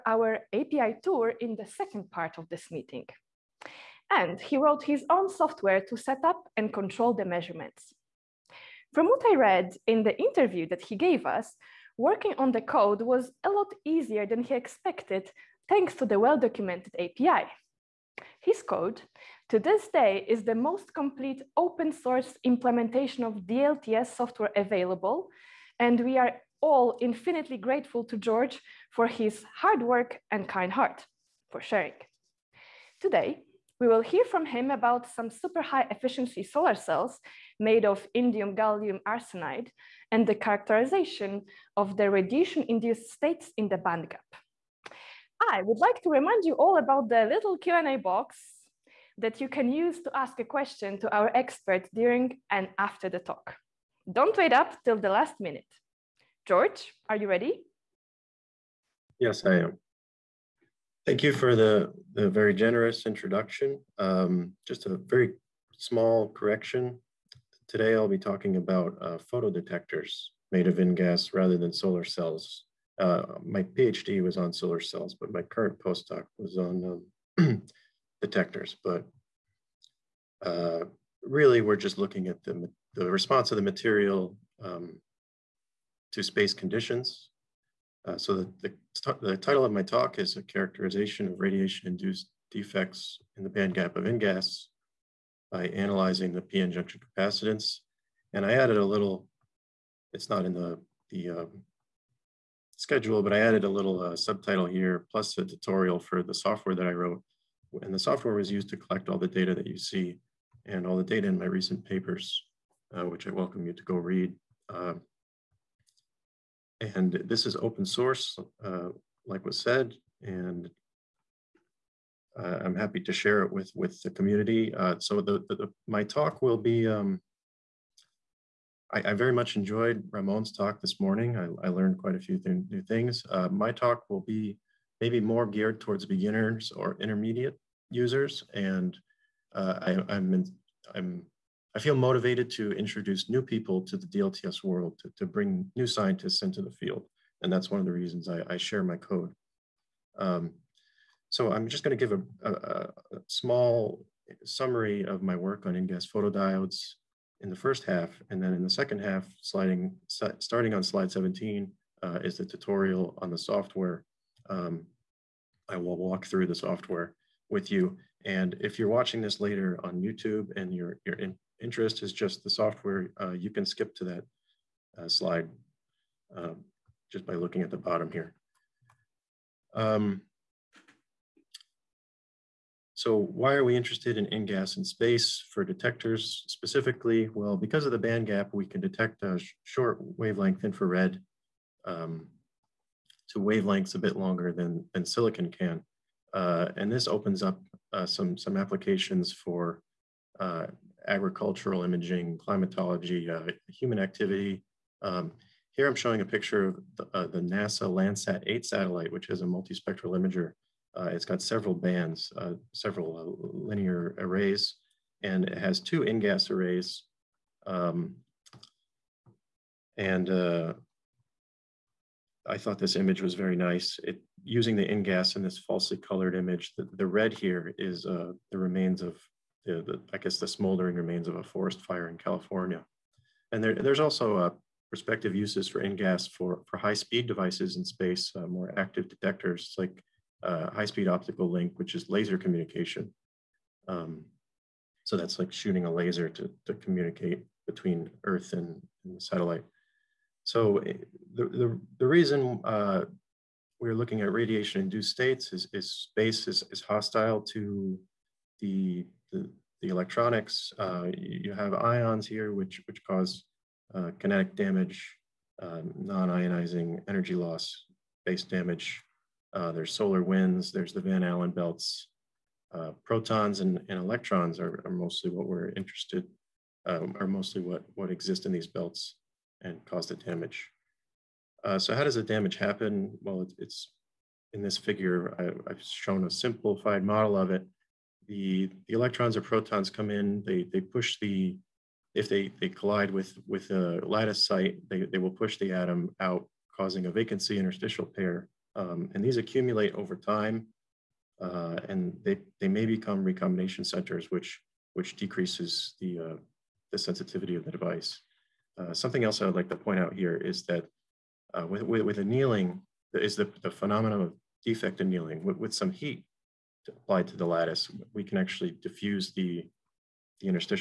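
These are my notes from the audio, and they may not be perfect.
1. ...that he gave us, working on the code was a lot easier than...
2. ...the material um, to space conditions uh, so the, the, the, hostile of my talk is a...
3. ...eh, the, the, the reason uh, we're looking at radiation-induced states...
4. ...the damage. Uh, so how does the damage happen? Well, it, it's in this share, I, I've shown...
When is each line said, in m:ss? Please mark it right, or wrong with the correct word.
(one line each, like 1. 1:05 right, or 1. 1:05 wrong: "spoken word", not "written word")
1. 0:10 right
2. 1:23 wrong: "title", not "hostile"
3. 4:10 right
4. 4:40 wrong: "figure", not "share".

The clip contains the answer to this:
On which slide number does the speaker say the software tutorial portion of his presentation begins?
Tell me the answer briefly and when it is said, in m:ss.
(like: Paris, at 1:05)
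17, at 2:40.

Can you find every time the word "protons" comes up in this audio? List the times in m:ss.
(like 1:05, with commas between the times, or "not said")
4:33, 4:49.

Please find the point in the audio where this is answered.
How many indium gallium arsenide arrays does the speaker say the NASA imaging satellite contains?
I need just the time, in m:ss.
3:35.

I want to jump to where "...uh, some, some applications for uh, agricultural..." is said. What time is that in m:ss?
3:17.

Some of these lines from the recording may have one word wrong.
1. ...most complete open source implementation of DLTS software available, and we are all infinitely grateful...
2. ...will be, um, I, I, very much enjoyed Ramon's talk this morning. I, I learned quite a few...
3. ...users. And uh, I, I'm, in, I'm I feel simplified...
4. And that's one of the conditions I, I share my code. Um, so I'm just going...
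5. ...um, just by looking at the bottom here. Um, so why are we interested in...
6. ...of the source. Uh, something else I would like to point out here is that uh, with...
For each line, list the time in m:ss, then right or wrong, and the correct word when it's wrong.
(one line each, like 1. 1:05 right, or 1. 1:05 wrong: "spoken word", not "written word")
1. 0:20 right
2. 2:06 right
3. 2:17 wrong: "motivated", not "simplified"
4. 2:27 wrong: "reasons", not "conditions"
5. 2:56 right
6. 5:07 wrong: "device", not "source".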